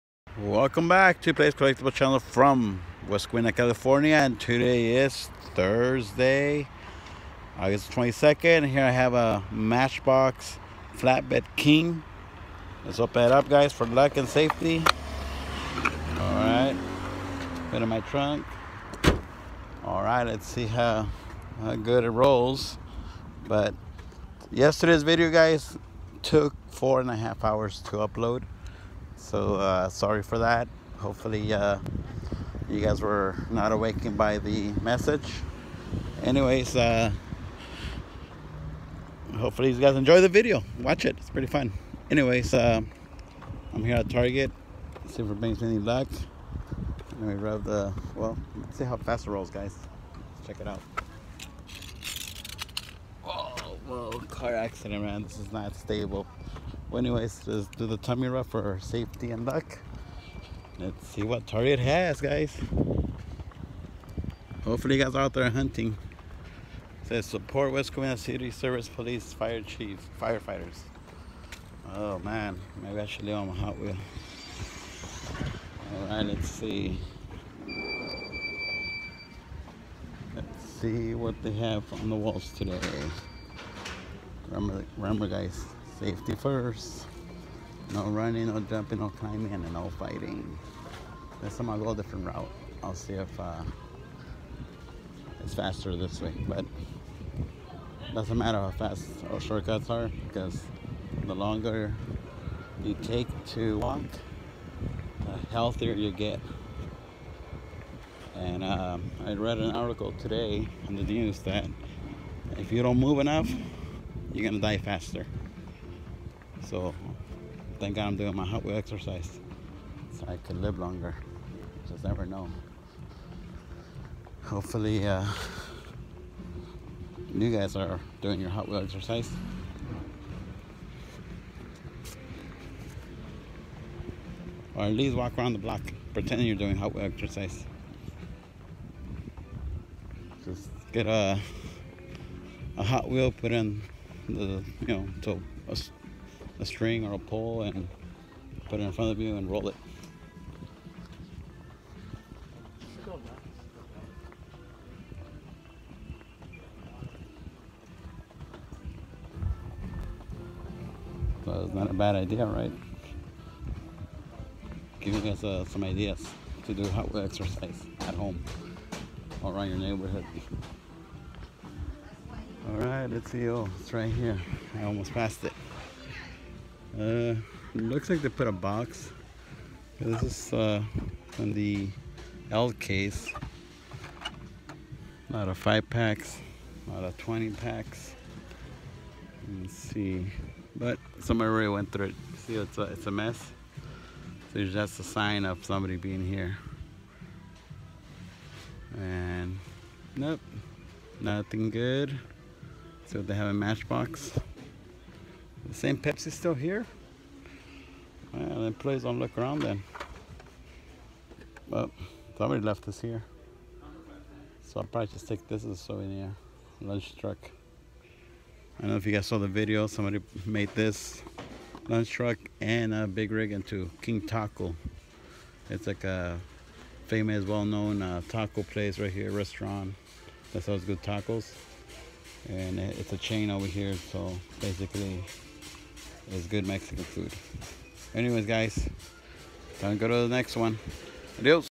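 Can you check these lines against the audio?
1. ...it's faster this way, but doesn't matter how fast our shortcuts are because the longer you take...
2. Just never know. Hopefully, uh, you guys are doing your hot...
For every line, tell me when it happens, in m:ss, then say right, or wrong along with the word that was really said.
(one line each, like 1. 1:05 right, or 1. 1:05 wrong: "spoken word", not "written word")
1. 1:35 right
2. 2:01 right.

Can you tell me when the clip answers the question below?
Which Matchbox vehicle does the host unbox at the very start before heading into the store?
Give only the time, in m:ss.
0:10.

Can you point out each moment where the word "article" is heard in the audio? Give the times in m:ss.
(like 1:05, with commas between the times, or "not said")
1:49.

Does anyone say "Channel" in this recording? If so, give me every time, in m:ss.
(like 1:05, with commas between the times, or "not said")
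0:01.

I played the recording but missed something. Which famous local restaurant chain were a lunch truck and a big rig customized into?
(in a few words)
King Taco.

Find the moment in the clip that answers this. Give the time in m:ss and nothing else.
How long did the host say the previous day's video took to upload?
0:26.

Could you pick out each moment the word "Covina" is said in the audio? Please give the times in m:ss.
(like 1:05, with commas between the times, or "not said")
0:03, 1:07.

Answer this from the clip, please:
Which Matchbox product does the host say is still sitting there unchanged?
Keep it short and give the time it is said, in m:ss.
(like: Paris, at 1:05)
Pepsi, at 3:25.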